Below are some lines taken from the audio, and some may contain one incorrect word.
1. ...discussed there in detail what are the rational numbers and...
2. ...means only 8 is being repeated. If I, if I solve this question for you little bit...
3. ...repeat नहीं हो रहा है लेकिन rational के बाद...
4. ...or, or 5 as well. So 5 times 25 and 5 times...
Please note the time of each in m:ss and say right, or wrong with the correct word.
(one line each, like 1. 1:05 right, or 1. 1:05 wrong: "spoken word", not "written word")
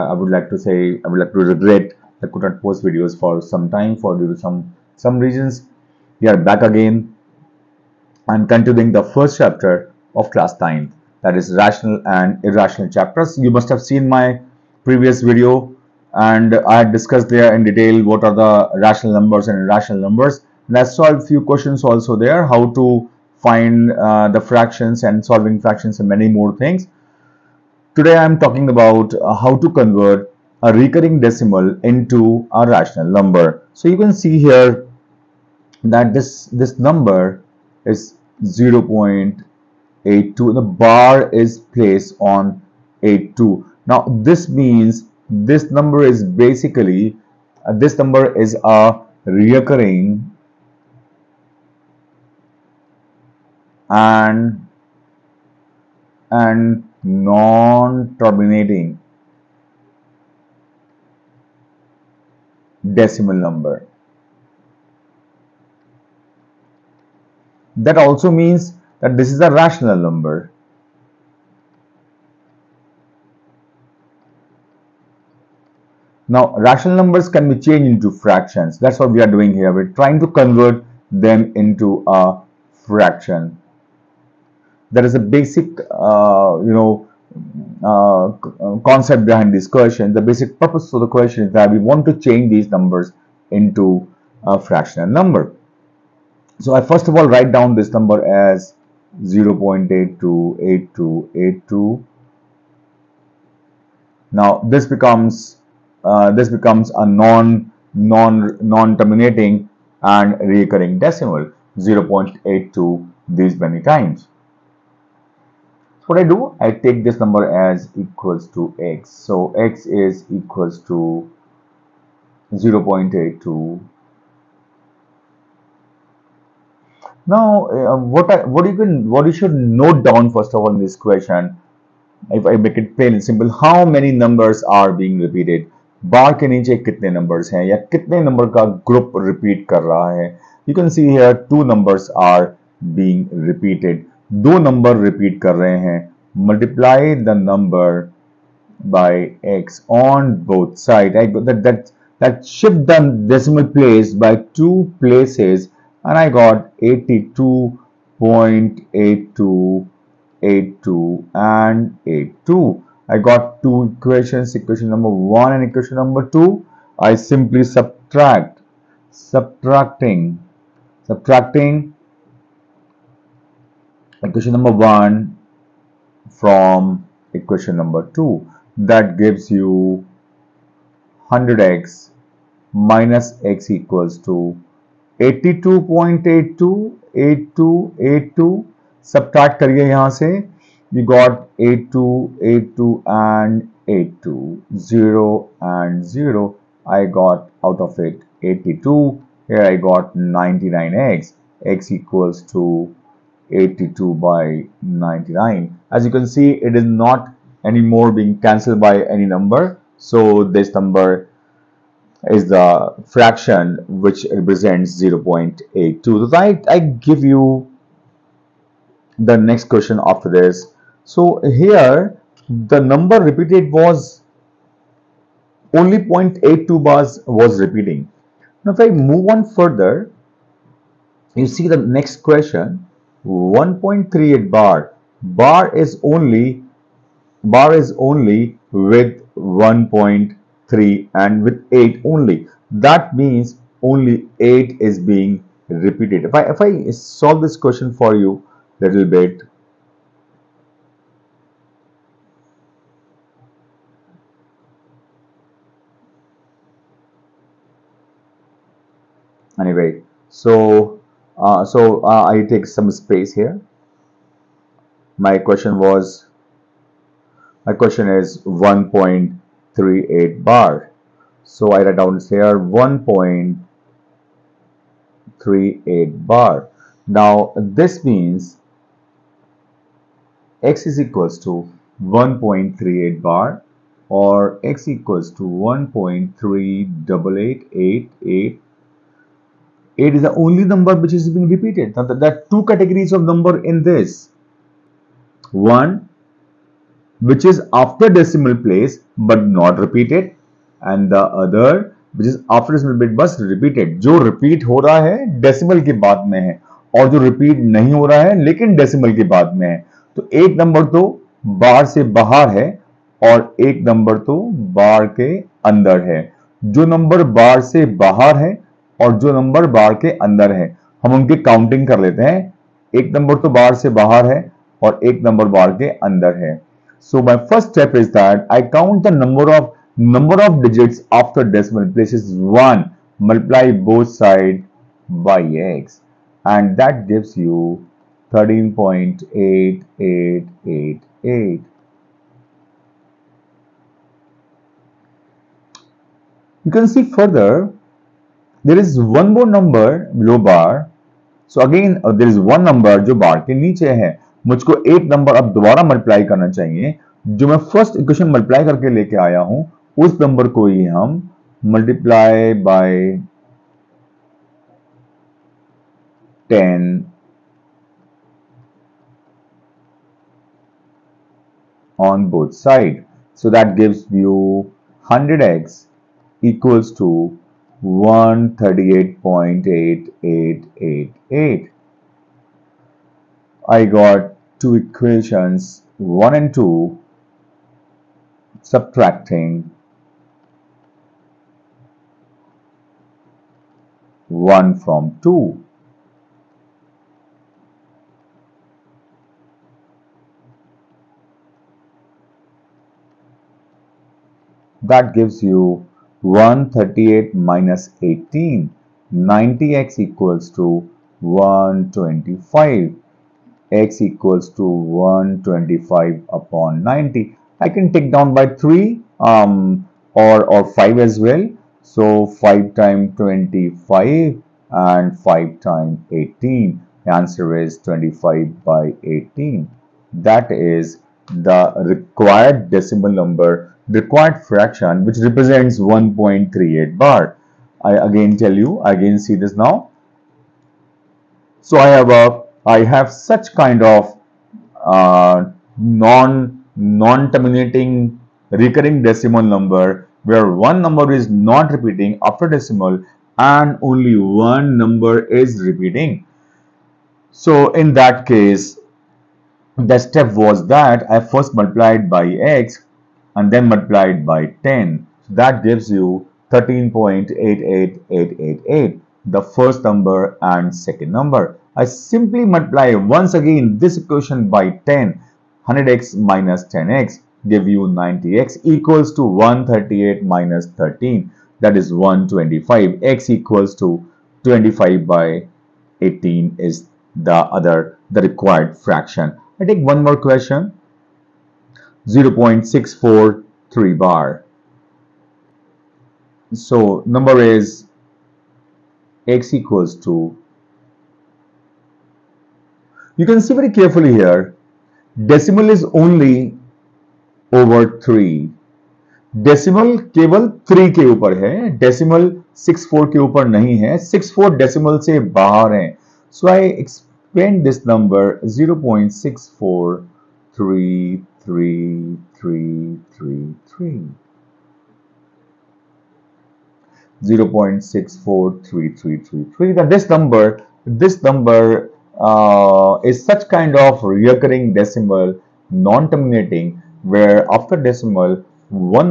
1. 0:16 right
2. 4:03 right
3. 5:07 wrong: "decimal", not "rational"
4. 7:00 right.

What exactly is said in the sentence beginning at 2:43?
I got two equations, equation number 1 and equation number 2.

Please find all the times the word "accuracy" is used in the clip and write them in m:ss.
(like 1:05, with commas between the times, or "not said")
not said.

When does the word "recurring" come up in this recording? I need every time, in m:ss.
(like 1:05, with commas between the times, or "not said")
0:30, 1:50, 7:28, 8:54.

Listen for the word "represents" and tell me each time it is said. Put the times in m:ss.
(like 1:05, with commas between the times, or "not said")
3:34, 7:15.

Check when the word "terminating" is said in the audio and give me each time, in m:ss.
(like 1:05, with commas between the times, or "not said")
0:57, 1:48, 7:27, 8:55.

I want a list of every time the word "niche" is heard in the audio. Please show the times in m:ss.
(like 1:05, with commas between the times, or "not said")
2:16, 5:53.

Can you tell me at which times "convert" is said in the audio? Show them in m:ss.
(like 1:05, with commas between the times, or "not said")
0:29, 1:20.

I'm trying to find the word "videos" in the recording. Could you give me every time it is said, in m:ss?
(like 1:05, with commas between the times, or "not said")
0:02, 0:15.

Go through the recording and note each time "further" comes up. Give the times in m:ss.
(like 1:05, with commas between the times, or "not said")
3:49, 5:47.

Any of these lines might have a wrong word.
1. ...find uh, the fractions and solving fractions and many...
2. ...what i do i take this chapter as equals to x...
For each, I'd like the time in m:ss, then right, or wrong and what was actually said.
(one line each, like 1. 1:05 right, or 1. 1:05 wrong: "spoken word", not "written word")
1. 0:23 right
2. 1:56 wrong: "number", not "chapter".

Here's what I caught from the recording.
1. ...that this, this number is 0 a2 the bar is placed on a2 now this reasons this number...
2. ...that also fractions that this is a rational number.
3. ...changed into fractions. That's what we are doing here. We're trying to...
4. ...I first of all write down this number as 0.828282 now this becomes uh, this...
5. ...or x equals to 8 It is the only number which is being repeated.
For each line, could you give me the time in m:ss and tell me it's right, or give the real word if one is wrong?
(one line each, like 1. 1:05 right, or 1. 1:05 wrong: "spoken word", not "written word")
1. 0:35 wrong: "means", not "reasons"
2. 1:07 wrong: "means", not "fractions"
3. 1:17 right
4. 1:36 right
5. 4:44 right.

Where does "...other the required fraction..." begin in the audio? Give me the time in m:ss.
8:07.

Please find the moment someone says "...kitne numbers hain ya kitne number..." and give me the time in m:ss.
2:16.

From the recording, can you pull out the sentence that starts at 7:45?
So that gives you 13.88888, the first number and second number.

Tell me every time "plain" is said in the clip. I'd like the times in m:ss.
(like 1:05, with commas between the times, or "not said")
2:12.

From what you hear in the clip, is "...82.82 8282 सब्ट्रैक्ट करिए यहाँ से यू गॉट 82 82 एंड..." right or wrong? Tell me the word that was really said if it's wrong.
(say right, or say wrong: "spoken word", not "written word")
right.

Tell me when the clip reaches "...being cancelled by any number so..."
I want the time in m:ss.
3:28.